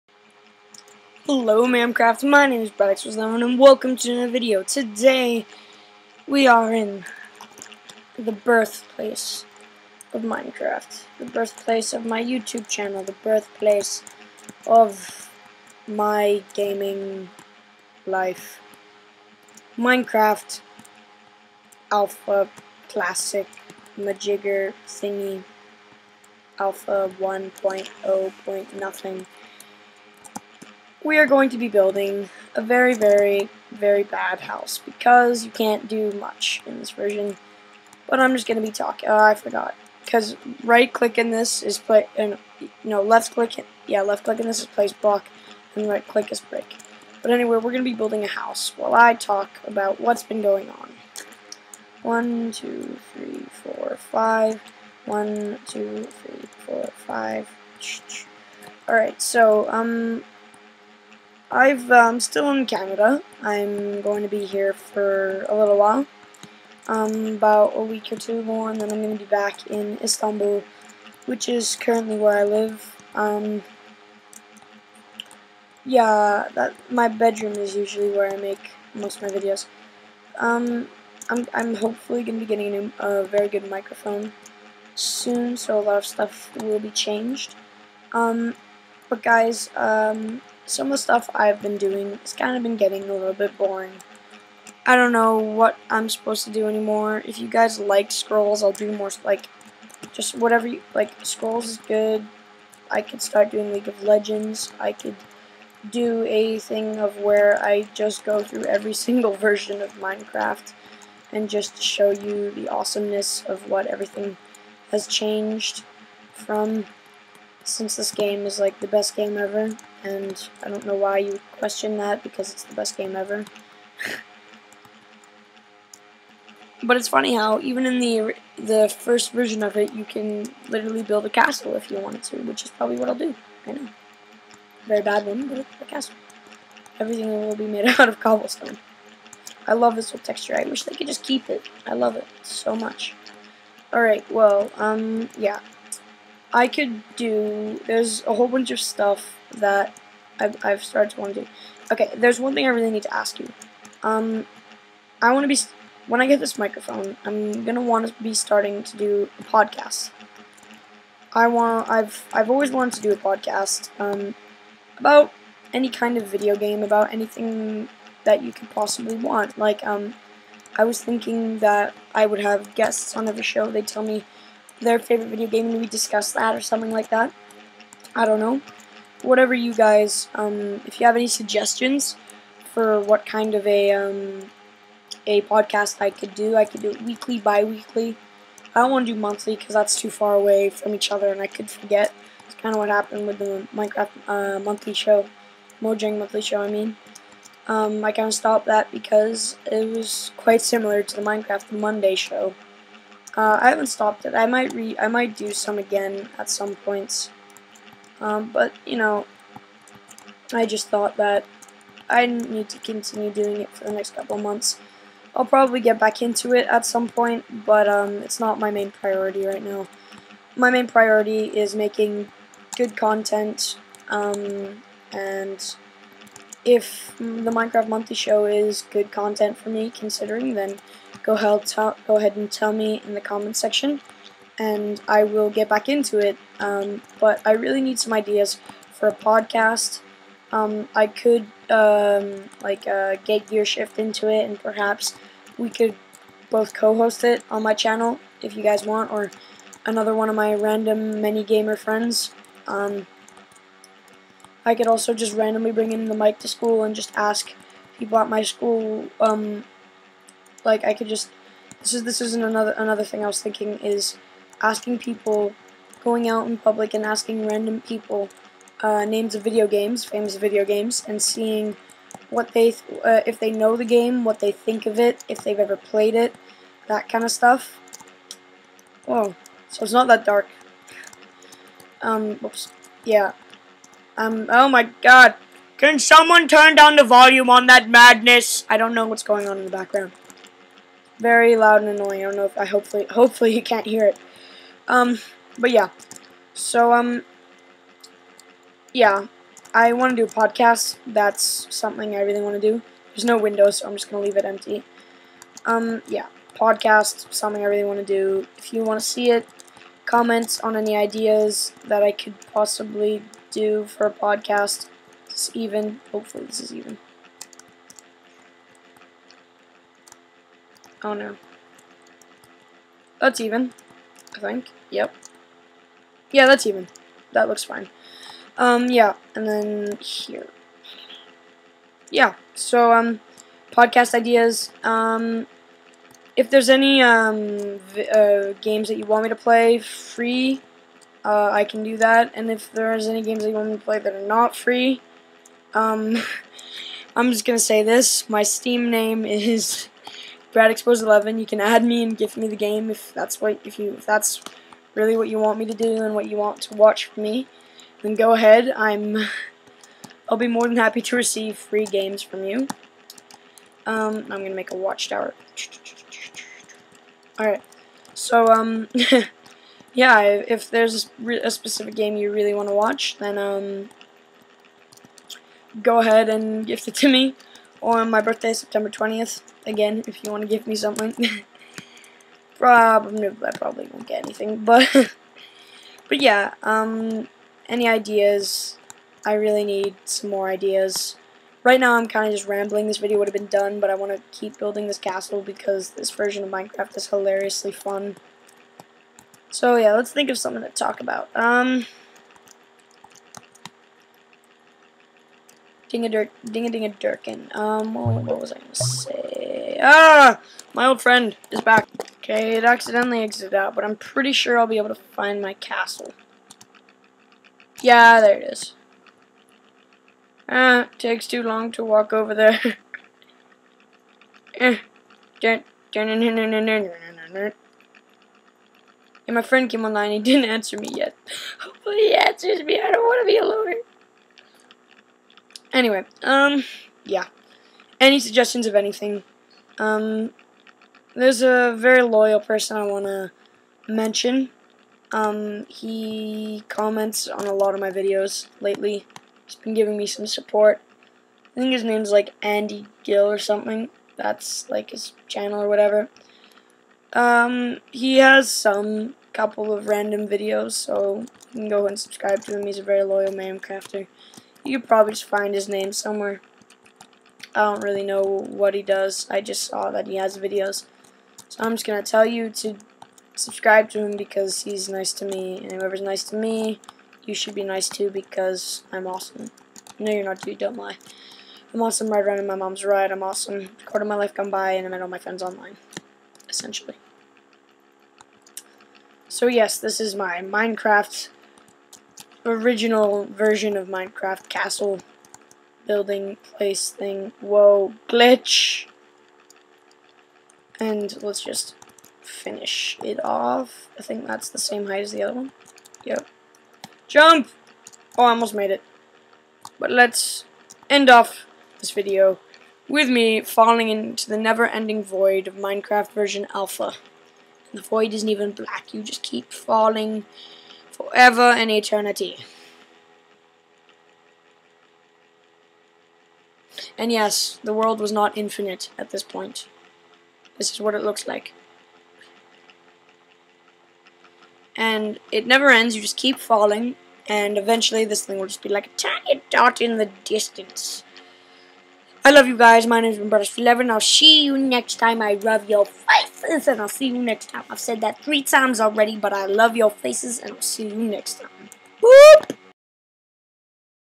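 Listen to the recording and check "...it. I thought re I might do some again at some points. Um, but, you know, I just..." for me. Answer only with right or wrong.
wrong.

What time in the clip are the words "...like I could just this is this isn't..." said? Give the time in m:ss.
4:20.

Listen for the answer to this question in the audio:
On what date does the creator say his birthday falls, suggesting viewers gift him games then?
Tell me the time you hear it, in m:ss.
6:18.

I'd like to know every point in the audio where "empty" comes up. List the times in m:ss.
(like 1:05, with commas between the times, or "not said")
5:04.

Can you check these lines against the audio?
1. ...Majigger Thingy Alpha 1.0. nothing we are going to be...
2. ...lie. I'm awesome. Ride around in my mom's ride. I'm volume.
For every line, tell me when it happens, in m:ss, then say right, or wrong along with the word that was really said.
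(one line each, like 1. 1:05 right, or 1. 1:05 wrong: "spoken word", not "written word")
1. 0:23 right
2. 8:00 wrong: "awesome", not "volume".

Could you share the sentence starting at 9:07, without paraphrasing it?
I've said that three times already, but I love your faces, and I'll see you next time.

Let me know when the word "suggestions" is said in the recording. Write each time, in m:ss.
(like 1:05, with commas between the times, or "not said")
3:01, 7:18.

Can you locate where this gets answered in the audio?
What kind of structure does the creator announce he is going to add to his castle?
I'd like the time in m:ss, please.
6:04.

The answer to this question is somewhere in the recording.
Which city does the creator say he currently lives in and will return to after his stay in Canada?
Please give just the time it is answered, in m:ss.
1:10.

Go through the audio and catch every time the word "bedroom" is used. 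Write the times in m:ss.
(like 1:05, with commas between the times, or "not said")
1:17.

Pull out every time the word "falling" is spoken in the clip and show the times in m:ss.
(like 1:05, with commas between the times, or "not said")
8:33, 8:39, 8:56.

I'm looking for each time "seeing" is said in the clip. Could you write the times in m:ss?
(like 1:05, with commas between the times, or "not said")
4:31.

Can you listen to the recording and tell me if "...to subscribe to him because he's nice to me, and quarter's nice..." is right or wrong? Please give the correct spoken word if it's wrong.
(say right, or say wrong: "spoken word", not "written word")
wrong: "whoever", not "quarter".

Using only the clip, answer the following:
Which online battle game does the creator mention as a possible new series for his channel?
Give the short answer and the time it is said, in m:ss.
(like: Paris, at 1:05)
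League of Legends, at 1:43.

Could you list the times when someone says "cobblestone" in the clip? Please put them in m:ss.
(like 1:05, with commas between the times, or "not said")
2:18.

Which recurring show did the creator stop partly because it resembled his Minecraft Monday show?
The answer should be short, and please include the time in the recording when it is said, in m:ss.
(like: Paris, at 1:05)
Mojang monthly show, at 3:15.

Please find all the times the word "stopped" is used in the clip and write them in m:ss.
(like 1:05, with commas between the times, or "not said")
3:18, 3:23.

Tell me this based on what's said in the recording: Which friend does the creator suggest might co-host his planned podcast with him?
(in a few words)
Gear Shift.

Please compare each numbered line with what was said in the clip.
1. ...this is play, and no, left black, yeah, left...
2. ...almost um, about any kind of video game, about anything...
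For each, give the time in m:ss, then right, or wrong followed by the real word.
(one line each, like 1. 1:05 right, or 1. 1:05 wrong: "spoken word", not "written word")
1. 0:41 wrong: "click", not "black"
2. 2:43 wrong: "podcast", not "almost".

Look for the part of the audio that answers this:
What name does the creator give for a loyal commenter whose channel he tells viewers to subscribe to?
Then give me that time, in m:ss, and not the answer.
7:32.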